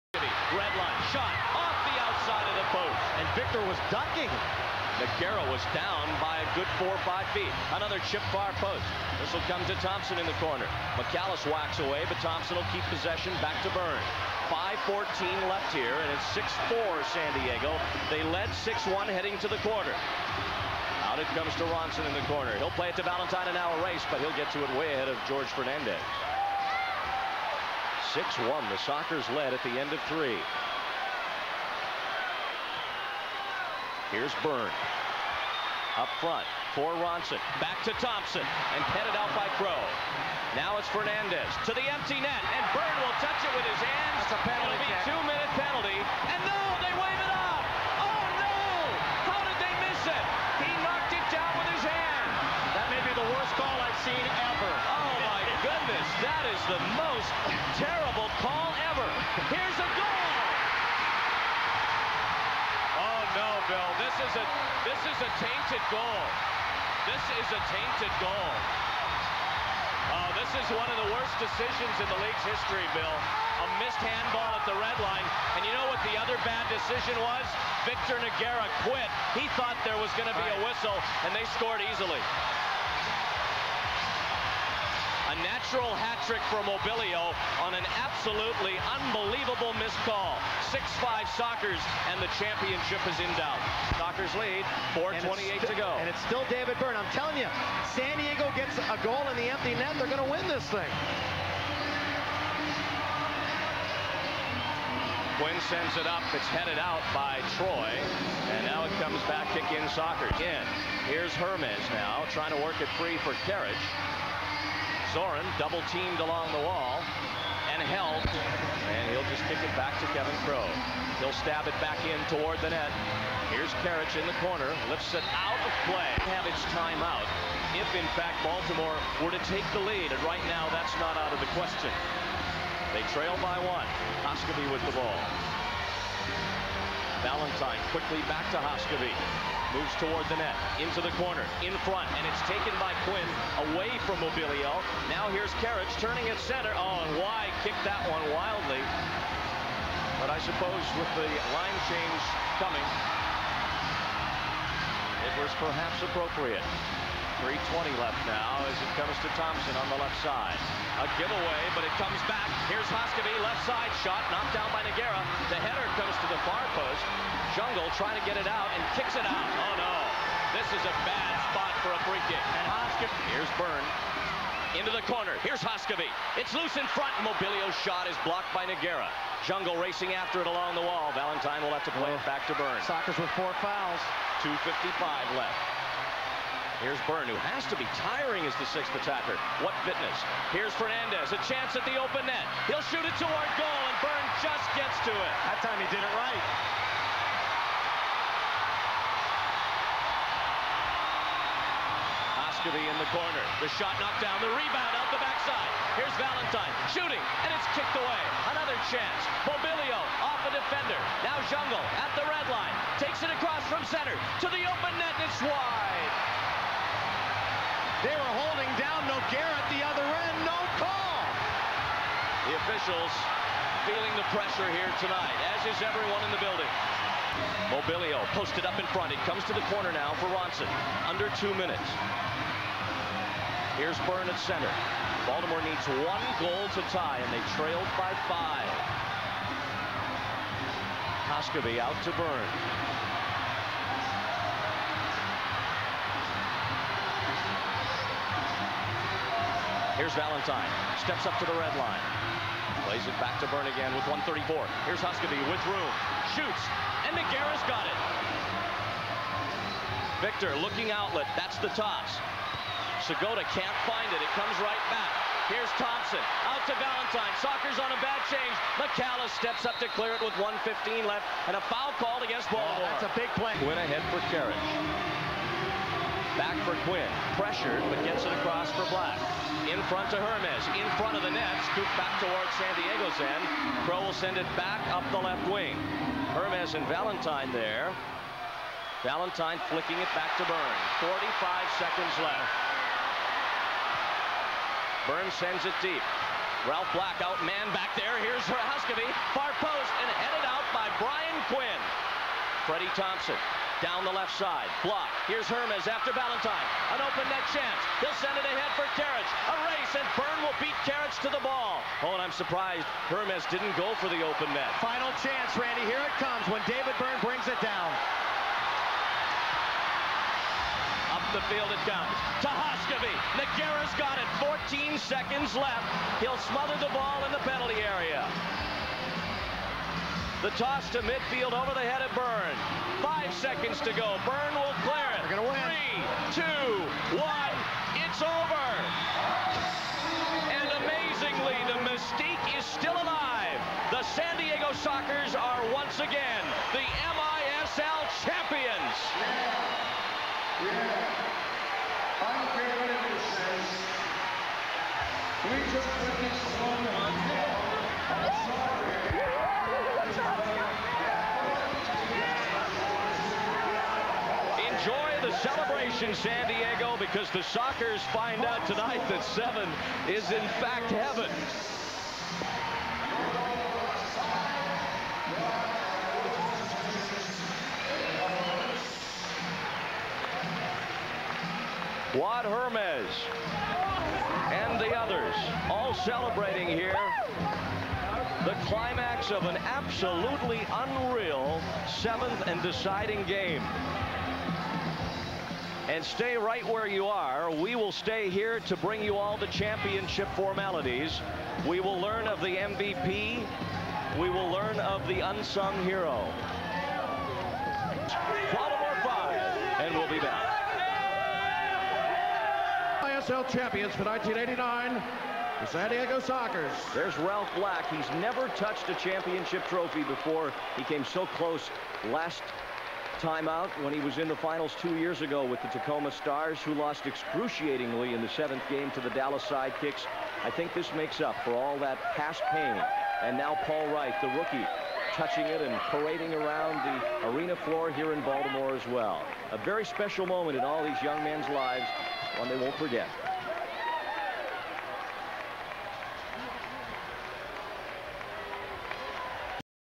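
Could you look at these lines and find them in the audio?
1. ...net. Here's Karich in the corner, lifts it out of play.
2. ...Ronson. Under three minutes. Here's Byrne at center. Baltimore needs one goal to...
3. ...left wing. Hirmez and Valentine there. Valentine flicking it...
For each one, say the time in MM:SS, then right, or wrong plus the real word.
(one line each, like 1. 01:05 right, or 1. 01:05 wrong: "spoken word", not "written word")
1. 02:02 right
2. 03:50 wrong: "two", not "three"
3. 04:45 right.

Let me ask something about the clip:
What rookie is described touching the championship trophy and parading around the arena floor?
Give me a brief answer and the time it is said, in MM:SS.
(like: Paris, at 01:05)
Paul Wright, at 07:13.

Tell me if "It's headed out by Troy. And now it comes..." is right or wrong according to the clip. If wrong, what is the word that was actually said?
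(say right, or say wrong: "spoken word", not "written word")
right.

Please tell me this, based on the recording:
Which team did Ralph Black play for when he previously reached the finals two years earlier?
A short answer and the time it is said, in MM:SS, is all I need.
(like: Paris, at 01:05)
Tacoma Stars, at 07:05.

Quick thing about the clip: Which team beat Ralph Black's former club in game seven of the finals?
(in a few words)
Dallas Sidekicks.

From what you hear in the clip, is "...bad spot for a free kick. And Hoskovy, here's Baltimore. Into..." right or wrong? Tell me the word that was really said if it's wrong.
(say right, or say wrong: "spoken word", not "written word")
wrong: "Byrne", not "Baltimore".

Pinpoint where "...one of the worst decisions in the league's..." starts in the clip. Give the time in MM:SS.
01:10.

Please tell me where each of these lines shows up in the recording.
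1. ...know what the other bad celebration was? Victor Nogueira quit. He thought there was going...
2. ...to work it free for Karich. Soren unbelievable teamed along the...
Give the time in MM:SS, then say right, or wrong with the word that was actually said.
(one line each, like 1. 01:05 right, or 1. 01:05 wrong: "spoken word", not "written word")
1. 01:15 wrong: "decision", not "celebration"
2. 01:52 wrong: "double", not "unbelievable".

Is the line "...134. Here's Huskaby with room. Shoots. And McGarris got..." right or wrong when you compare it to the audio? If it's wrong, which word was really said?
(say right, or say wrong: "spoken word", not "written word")
right.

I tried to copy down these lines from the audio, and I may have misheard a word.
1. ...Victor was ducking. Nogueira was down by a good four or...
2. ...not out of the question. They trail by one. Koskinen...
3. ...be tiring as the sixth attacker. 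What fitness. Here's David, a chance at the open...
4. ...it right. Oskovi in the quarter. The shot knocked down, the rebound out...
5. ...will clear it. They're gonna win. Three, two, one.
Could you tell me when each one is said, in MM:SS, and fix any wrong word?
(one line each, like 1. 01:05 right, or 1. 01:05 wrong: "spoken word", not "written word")
1. 00:03 right
2. 02:11 right
3. 03:07 wrong: "Fernandez", not "David"
4. 03:16 wrong: "corner", not "quarter"
5. 05:34 right.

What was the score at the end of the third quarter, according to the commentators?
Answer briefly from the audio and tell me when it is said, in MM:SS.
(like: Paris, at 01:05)
6-1, at 00:18.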